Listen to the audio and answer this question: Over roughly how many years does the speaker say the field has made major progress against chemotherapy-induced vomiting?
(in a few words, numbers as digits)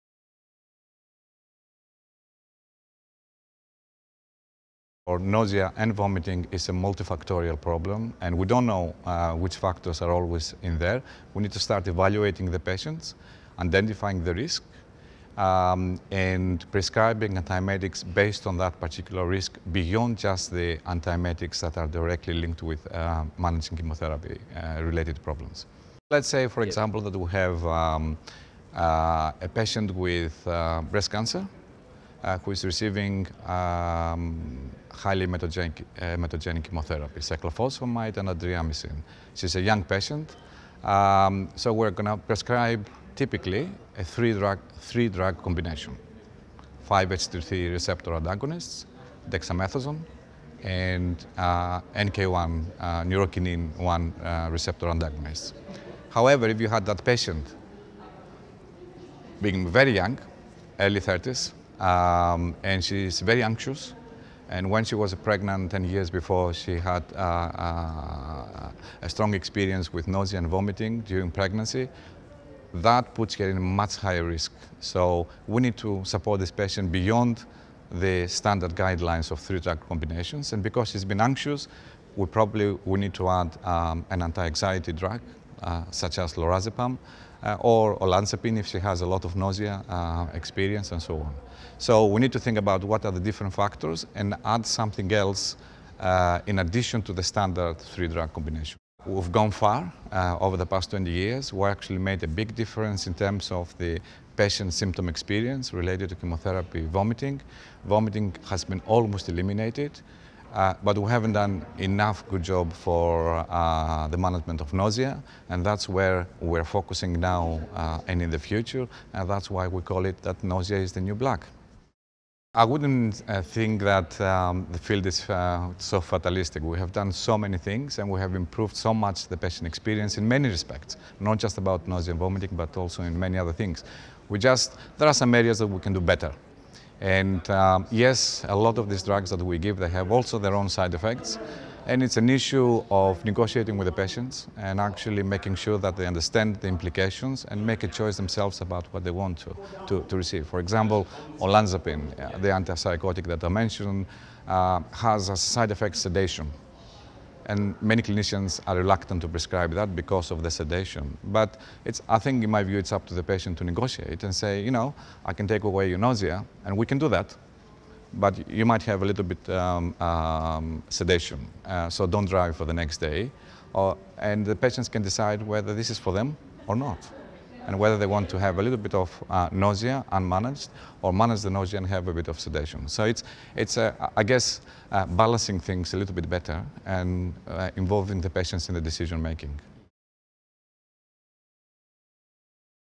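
20.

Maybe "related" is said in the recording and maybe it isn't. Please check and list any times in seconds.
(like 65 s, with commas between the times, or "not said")
24 s, 105 s.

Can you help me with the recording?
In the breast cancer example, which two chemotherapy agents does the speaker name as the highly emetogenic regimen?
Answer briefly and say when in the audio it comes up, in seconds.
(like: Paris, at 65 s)
cyclophosphamide and adriamycin, at 37 s.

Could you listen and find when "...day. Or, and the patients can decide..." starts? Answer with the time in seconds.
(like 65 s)
172 s.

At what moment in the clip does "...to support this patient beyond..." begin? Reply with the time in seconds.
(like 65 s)
75 s.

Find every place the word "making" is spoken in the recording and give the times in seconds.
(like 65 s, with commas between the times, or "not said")
145 s, 189 s.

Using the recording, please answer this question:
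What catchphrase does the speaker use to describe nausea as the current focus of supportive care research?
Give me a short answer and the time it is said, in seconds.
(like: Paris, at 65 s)
the new black, at 120 s.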